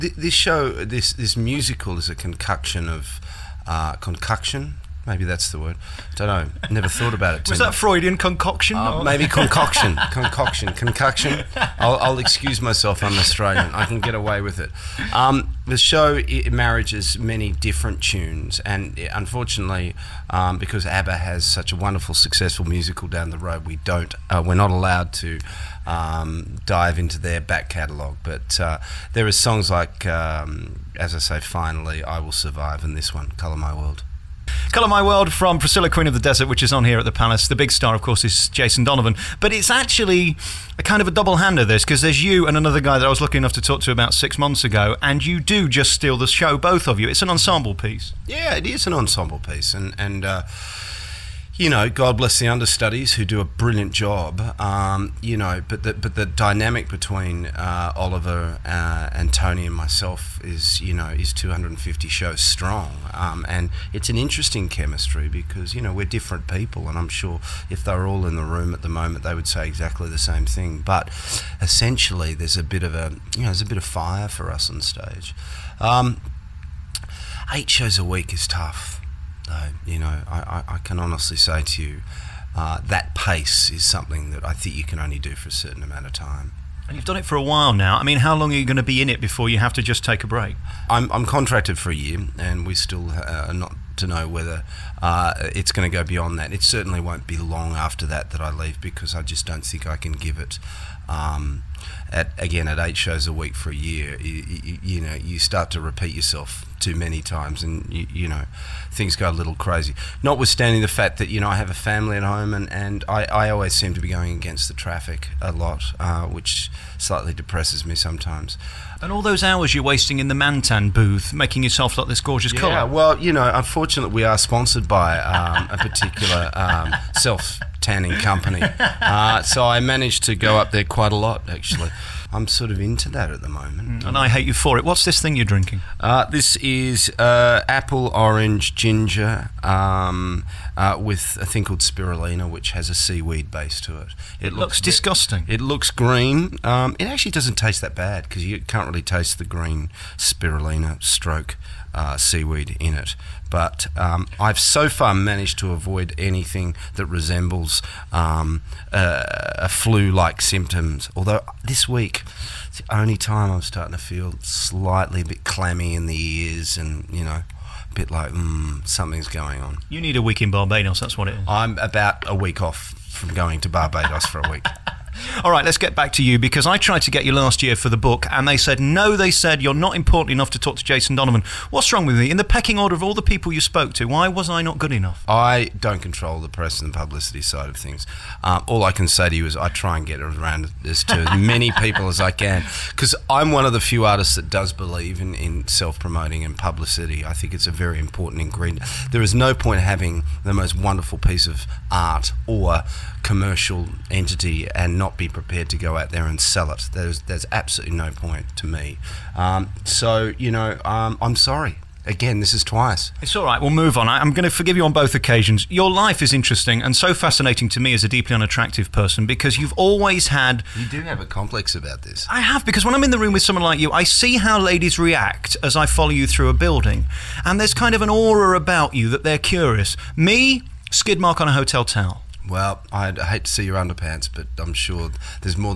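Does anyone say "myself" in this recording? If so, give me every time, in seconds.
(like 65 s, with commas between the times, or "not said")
12 s, 59 s.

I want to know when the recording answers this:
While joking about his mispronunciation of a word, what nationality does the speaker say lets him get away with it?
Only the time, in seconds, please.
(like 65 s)
13 s.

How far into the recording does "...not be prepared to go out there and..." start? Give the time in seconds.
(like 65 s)
205 s.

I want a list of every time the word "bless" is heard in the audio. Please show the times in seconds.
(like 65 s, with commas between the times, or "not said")
52 s.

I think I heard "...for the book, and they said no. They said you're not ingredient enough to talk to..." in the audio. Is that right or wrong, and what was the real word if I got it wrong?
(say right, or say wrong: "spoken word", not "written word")
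wrong: "important", not "ingredient".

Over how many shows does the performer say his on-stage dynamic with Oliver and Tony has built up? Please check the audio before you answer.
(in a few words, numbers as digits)
250.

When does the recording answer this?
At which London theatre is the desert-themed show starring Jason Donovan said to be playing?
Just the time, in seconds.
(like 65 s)
37 s.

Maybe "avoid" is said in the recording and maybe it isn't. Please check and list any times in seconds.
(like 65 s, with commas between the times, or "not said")
155 s.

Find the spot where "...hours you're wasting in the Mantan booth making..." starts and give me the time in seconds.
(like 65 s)
119 s.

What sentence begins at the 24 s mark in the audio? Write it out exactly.
Uh, we're not allowed to um, dive into their back catalogue.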